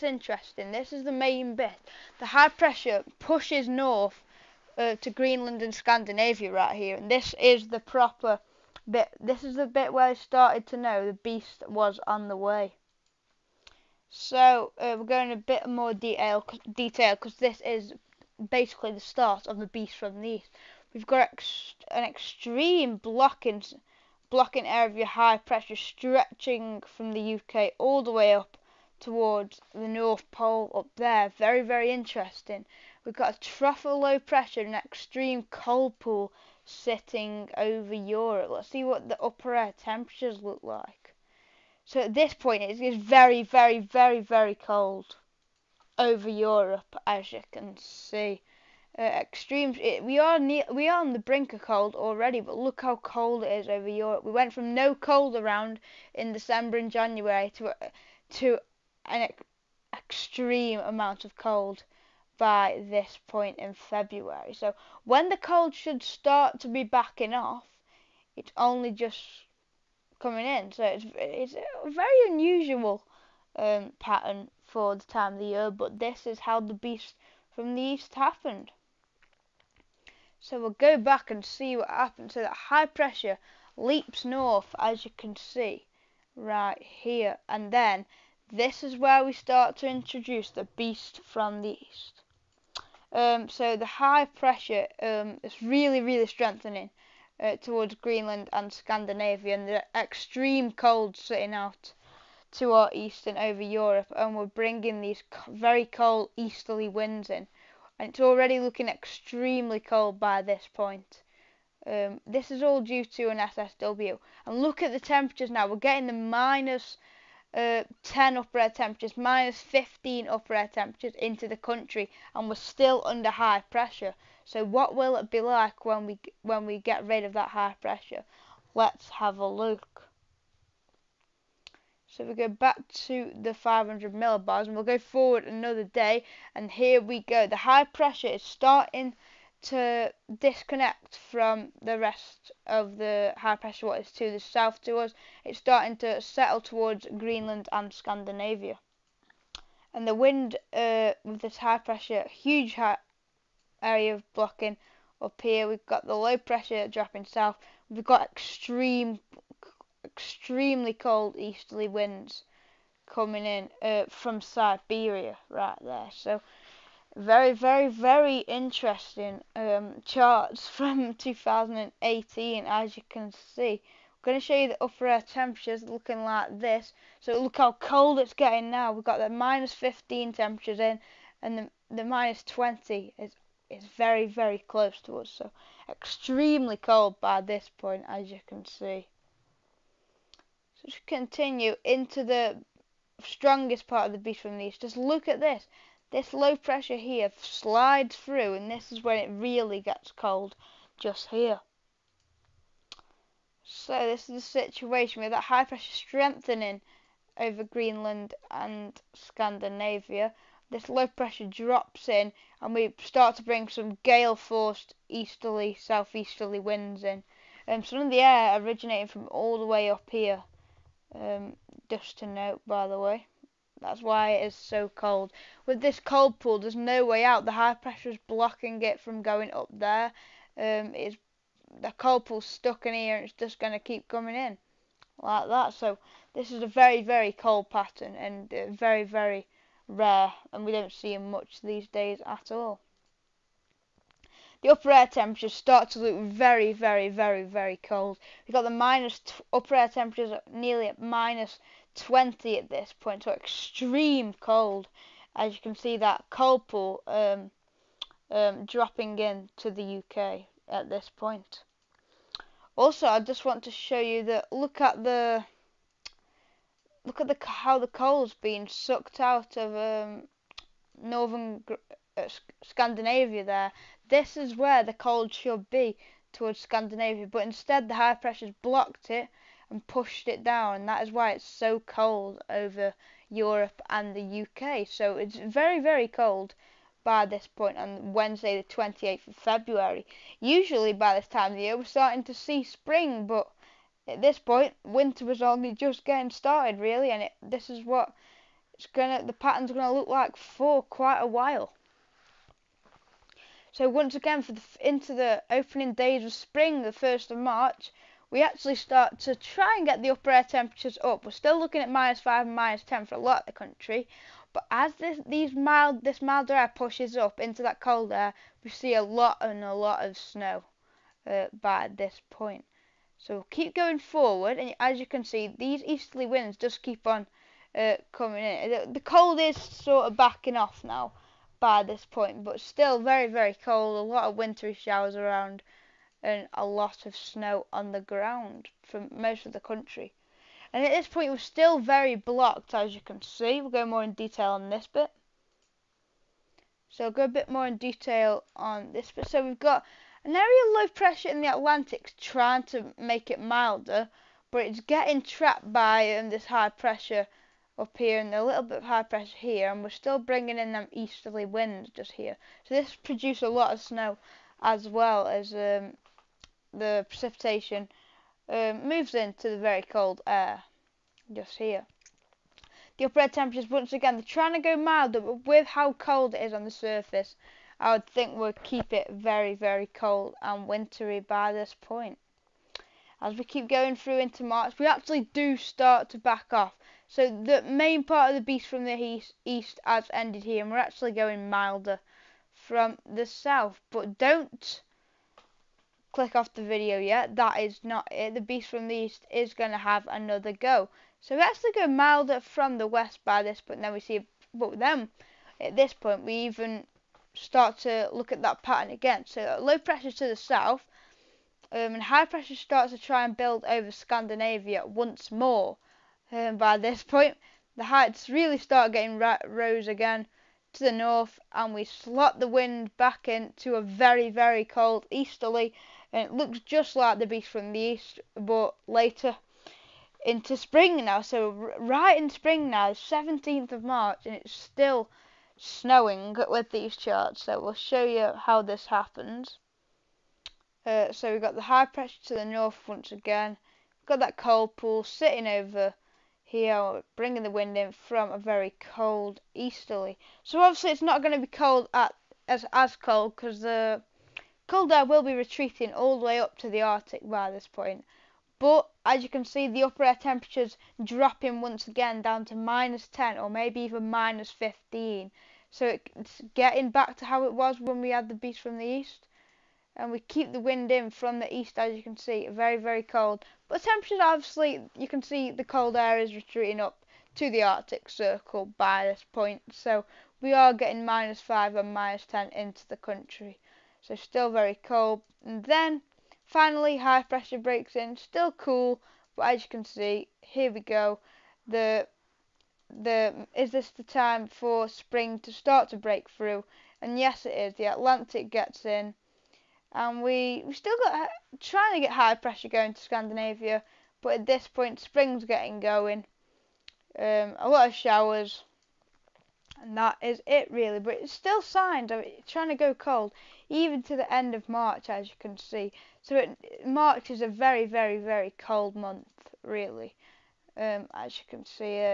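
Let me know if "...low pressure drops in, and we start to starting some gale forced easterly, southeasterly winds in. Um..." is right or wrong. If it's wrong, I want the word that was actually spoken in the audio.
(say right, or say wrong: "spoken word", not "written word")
wrong: "bring", not "starting".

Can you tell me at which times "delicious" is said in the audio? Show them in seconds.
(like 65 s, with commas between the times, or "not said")
not said.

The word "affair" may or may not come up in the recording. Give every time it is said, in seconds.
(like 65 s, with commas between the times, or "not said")
not said.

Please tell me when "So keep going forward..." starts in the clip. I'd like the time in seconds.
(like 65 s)
323 s.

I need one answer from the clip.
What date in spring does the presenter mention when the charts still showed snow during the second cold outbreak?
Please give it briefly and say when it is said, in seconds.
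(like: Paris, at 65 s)
17 March, at 432 s.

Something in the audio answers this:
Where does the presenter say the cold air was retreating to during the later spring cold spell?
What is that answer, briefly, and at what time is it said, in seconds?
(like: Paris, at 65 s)
Arctic circle, at 477 s.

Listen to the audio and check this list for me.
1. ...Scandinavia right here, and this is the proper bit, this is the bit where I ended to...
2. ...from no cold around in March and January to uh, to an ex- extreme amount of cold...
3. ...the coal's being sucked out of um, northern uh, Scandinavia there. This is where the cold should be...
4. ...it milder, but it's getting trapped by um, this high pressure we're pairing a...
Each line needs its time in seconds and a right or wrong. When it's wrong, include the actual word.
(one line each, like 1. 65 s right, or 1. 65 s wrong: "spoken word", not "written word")
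1. 5 s wrong: "started", not "ended"
2. 54 s wrong: "December", not "March"
3. 267 s right
4. 353 s right.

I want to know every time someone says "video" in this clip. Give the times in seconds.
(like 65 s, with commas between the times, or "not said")
396 s.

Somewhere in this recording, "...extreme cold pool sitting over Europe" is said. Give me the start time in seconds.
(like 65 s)
34 s.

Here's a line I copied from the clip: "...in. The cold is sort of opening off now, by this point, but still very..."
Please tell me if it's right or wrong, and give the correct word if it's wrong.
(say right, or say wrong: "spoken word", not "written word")
wrong: "backing", not "opening".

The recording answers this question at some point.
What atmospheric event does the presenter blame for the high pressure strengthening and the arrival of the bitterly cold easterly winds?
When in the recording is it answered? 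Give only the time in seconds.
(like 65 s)
113 s.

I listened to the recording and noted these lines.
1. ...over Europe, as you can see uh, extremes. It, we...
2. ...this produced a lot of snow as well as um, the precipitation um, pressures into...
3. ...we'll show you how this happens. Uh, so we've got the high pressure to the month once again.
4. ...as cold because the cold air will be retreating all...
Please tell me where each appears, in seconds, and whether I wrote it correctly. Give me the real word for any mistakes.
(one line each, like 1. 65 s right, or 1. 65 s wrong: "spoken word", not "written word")
1. 45 s right
2. 362 s wrong: "moves", not "pressures"
3. 437 s wrong: "north", not "month"
4. 452 s right.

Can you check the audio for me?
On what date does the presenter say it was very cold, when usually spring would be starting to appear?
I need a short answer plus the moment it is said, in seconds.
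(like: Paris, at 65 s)
Wednesday 28 February, at 288 s.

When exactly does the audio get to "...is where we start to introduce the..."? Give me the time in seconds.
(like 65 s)
88 s.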